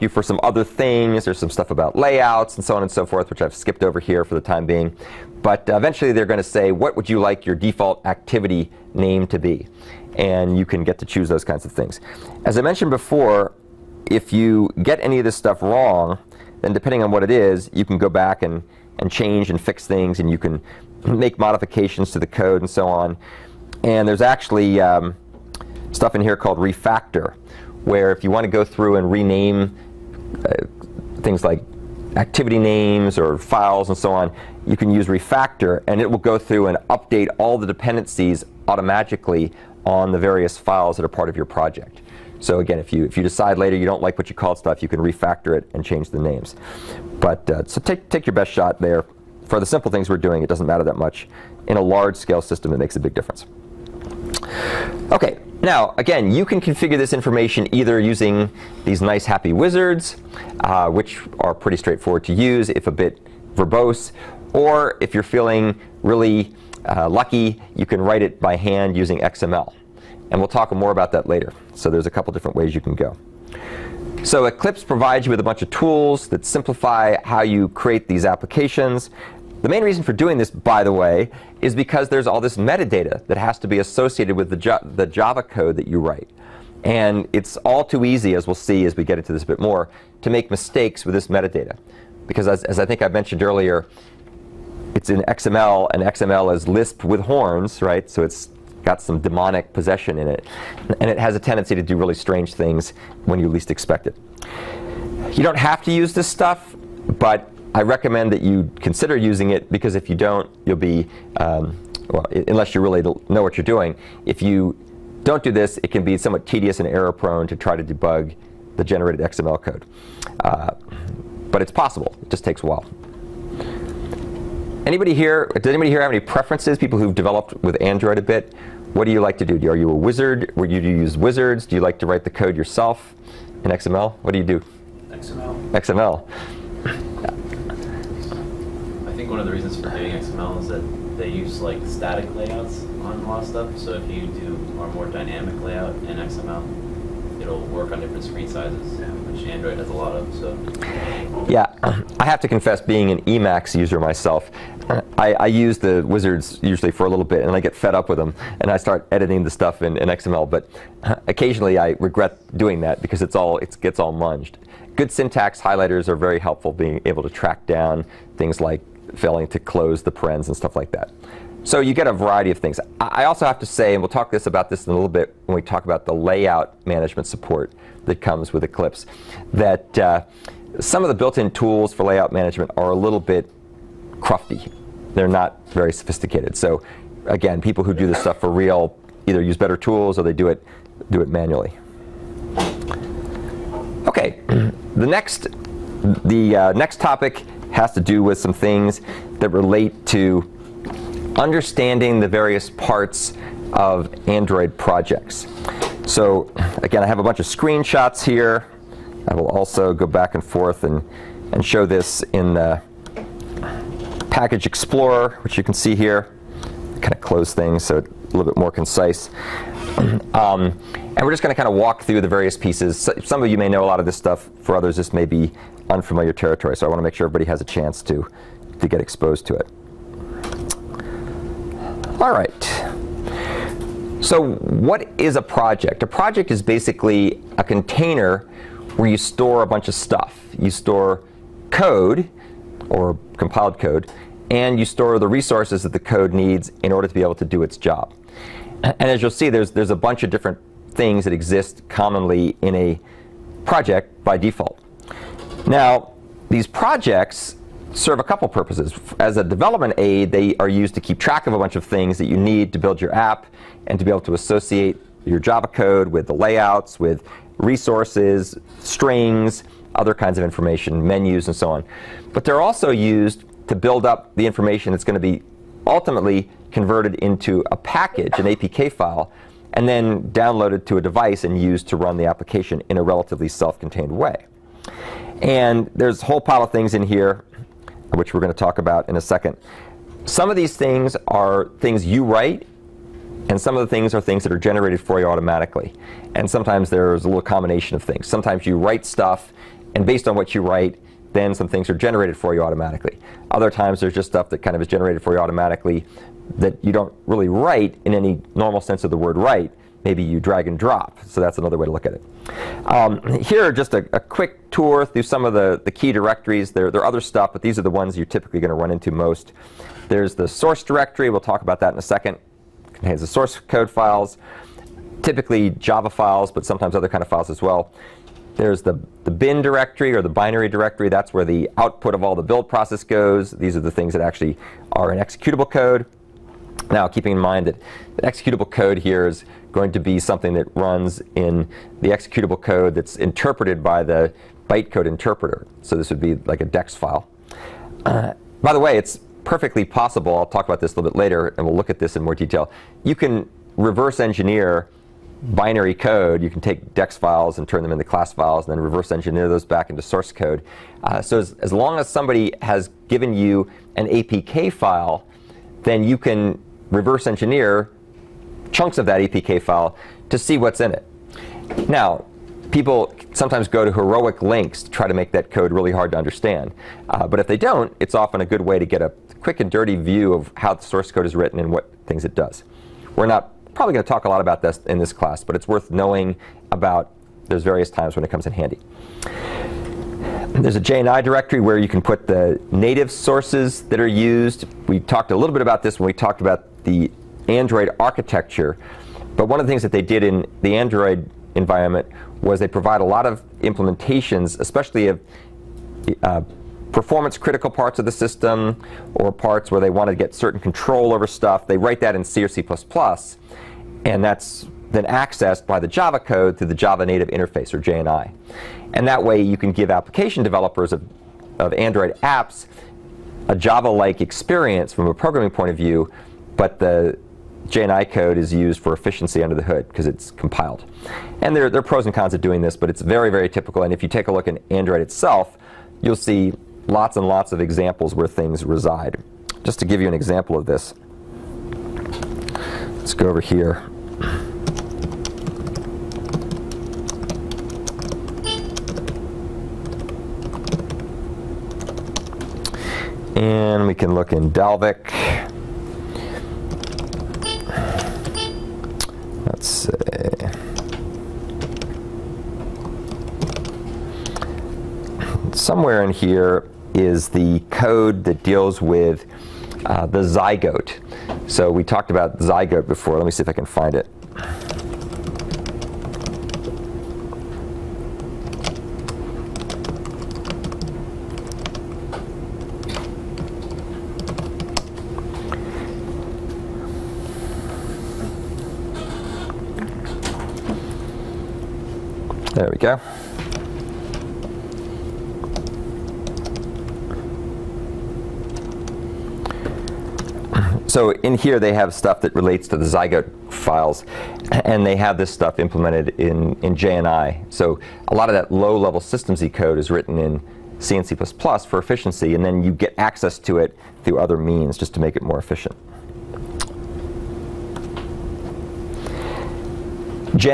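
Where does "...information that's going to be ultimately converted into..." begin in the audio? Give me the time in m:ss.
4:34.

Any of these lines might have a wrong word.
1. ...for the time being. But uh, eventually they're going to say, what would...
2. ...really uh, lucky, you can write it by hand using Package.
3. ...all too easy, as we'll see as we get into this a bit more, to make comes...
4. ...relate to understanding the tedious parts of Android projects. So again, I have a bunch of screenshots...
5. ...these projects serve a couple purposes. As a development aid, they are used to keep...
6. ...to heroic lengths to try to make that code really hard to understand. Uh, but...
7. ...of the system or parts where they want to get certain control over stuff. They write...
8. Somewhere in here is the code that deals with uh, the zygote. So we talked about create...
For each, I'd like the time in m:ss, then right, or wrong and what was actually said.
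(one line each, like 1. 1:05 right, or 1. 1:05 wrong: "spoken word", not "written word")
1. 0:04 right
2. 1:06 wrong: "XML", not "Package"
3. 1:27 wrong: "mistakes", not "comes"
4. 3:19 wrong: "various", not "tedious"
5. 4:16 right
6. 6:13 right
7. 6:47 right
8. 7:45 wrong: "zygote", not "create".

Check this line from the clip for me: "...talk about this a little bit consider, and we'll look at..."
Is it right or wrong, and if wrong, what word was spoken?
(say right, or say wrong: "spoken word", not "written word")
wrong: "later", not "consider".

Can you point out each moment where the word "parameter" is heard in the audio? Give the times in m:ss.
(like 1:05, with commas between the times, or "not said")
not said.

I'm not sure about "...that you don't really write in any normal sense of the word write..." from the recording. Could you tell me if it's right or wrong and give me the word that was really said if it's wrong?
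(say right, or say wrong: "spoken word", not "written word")
right.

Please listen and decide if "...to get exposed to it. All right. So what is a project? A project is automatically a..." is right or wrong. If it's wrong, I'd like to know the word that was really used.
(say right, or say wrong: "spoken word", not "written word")
wrong: "basically", not "automatically".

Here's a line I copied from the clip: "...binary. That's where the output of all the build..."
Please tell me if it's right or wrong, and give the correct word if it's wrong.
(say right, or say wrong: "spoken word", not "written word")
wrong: "directory", not "binary".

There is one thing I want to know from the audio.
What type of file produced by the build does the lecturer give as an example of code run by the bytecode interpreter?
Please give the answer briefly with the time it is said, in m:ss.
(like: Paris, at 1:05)
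DEX file, at 5:46.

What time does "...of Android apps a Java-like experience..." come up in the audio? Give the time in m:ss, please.
7:01.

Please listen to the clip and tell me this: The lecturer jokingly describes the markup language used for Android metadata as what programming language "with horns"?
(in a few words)
Lisp.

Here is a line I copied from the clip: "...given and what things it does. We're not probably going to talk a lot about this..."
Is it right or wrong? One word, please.
wrong.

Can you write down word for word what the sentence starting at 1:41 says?
And it has a tendency to do really strange things when you least expect it.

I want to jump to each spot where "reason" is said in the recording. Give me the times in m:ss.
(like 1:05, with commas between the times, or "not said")
1:19, 2:19.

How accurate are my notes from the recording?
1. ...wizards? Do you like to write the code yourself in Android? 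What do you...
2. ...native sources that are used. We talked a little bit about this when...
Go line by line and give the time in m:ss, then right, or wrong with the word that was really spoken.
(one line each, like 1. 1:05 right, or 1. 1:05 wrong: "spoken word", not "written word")
1. 2:11 wrong: "XML", not "Android"
2. 6:32 right.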